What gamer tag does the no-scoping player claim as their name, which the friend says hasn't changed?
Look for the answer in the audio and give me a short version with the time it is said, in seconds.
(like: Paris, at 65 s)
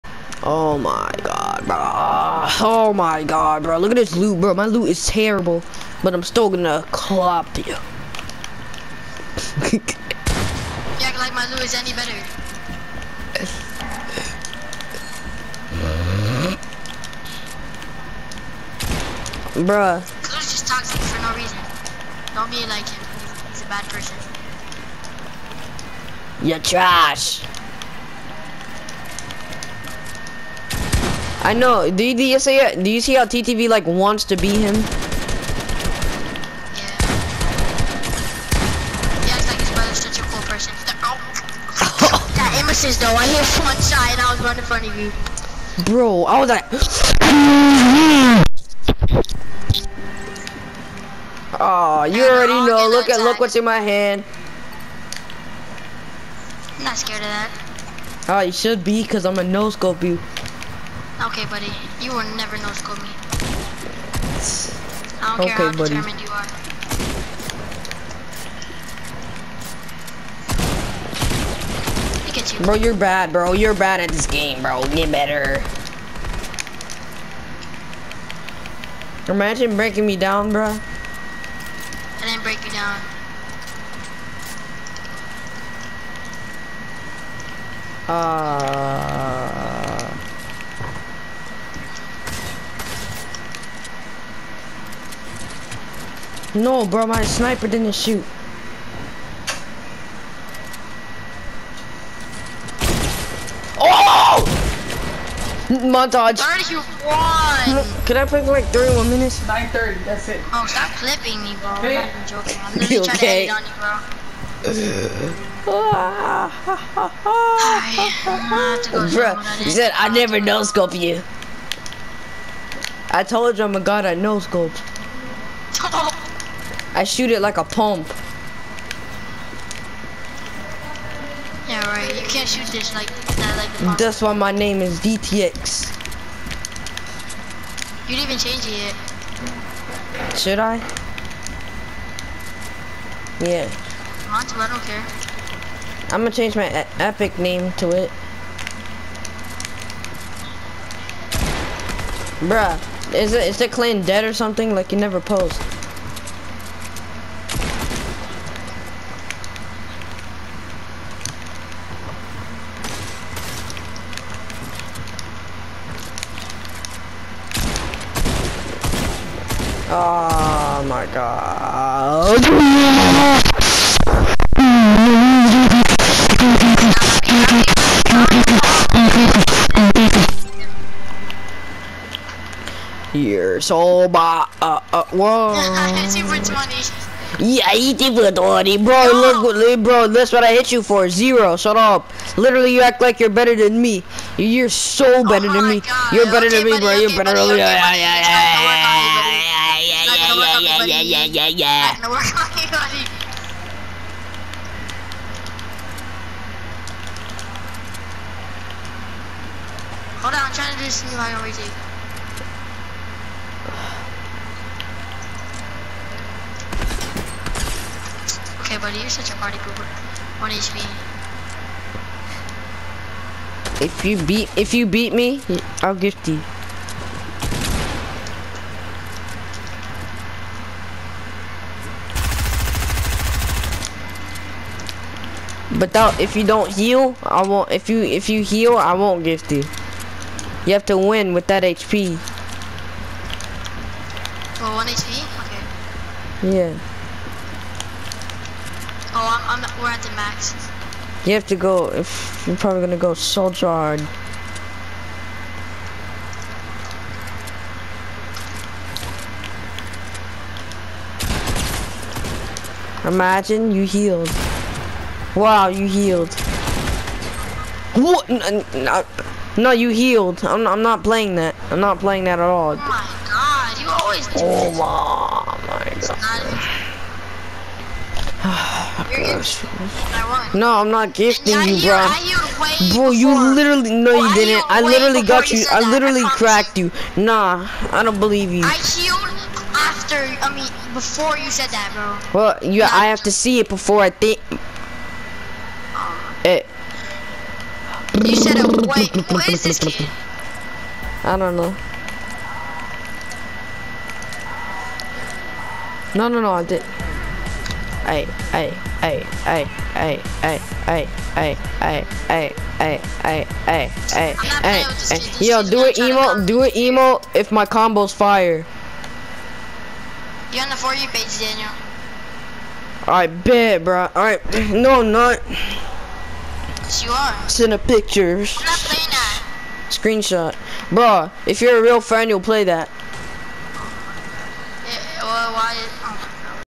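DTX, at 134 s.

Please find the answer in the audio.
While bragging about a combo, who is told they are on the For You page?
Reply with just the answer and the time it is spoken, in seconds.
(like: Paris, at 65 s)
Daniel, at 321 s.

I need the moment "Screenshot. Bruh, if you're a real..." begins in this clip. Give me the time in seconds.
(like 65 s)
329 s.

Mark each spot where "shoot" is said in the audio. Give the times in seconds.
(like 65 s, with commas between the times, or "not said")
97 s, 127 s, 132 s.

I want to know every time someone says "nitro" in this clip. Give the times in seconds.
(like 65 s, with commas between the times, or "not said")
not said.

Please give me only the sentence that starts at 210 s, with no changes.
Hold on, I'm trying to do this line already.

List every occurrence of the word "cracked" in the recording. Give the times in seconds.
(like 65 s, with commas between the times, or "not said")
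286 s.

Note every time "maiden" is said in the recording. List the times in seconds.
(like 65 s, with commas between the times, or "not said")
not said.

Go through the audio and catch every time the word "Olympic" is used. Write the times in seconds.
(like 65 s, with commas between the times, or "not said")
not said.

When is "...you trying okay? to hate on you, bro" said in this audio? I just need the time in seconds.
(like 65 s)
112 s.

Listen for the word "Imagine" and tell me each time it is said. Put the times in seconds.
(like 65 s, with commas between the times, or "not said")
79 s, 263 s.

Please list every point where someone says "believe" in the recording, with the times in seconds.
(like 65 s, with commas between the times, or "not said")
288 s.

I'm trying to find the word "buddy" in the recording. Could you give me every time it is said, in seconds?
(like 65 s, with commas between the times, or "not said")
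61 s, 65 s, 196 s, 218 s.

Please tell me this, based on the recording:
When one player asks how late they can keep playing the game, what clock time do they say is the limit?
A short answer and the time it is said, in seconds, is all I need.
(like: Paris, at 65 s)
9:30, at 109 s.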